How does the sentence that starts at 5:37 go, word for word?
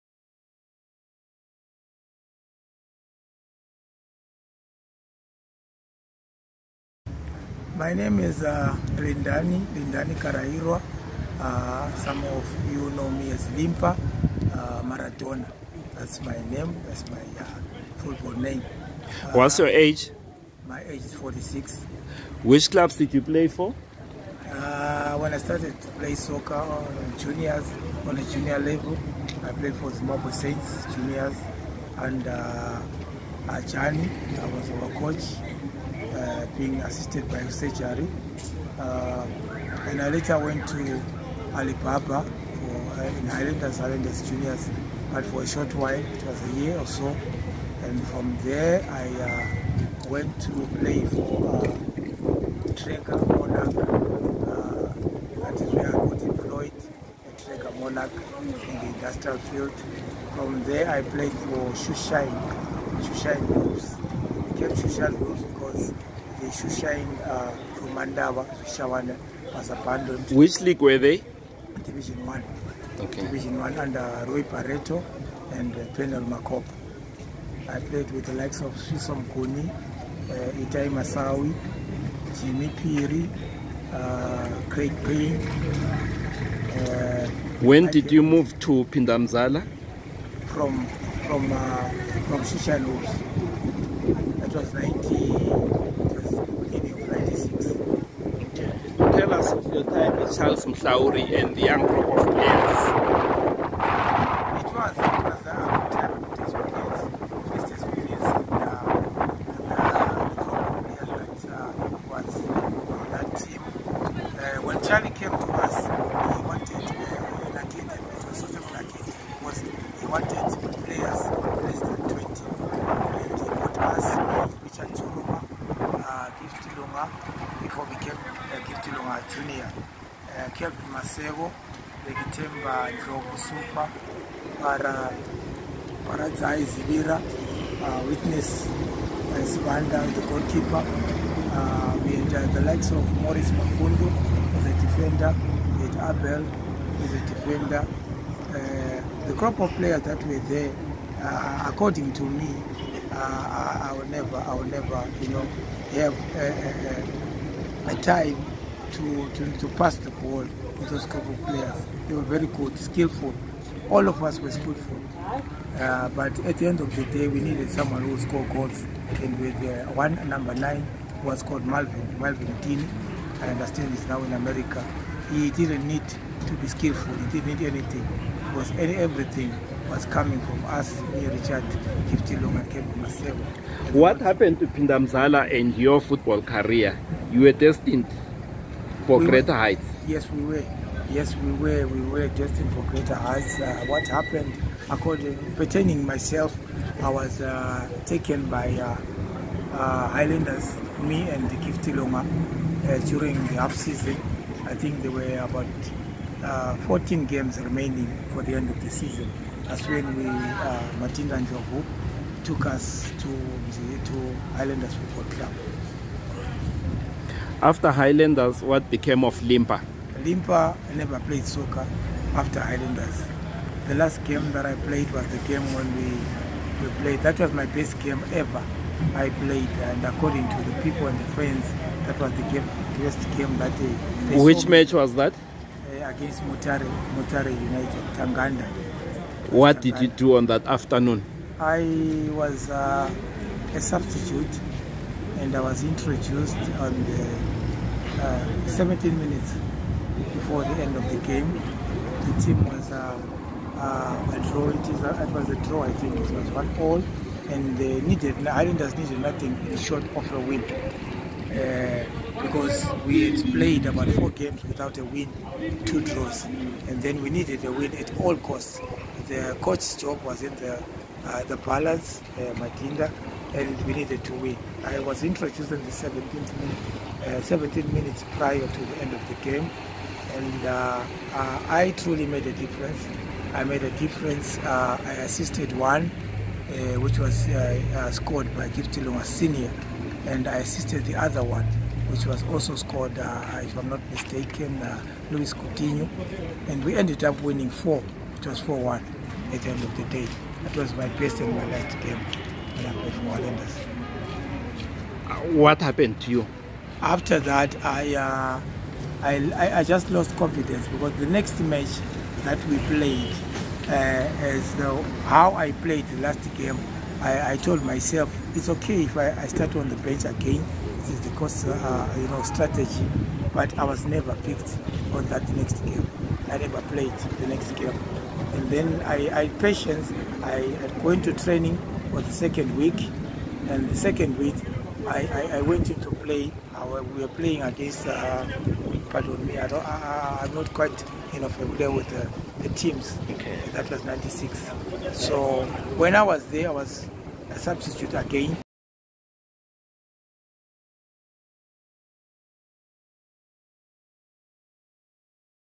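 we were playing against, uh, pardon me, I don't, I, am not quite you know, familiar with the, the teams.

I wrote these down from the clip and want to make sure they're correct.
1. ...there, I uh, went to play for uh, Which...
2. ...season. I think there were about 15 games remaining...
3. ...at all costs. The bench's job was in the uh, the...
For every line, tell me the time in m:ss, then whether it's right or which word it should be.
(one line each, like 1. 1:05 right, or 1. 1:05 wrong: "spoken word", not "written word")
1. 0:48 wrong: "Treka", not "Which"
2. 3:23 wrong: "14", not "15"
3. 4:27 wrong: "coach", not "bench".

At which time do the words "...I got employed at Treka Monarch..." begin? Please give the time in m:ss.
0:55.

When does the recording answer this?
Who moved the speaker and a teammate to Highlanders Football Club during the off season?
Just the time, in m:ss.
3:31.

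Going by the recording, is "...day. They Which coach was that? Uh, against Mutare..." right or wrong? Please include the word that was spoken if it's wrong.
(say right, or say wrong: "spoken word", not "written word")
wrong: "match", not "coach".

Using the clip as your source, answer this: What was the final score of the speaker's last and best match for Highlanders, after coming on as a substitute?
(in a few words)
4-1.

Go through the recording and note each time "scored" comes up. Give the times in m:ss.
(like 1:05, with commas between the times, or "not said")
2:48, 4:48, 4:52.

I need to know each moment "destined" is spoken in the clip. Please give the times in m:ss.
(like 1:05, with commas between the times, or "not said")
3:07, 3:12.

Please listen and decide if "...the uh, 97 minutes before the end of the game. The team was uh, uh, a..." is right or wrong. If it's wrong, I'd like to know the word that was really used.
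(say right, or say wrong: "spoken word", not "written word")
wrong: "17", not "97".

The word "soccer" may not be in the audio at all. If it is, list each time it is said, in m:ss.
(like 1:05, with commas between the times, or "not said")
0:26, 3:41.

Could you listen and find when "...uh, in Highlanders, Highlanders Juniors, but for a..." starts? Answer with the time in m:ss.
0:43.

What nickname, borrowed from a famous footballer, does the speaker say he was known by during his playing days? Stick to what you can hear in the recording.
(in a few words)
Maradona.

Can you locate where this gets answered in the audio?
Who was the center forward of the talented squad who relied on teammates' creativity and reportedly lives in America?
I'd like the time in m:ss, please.
2:52.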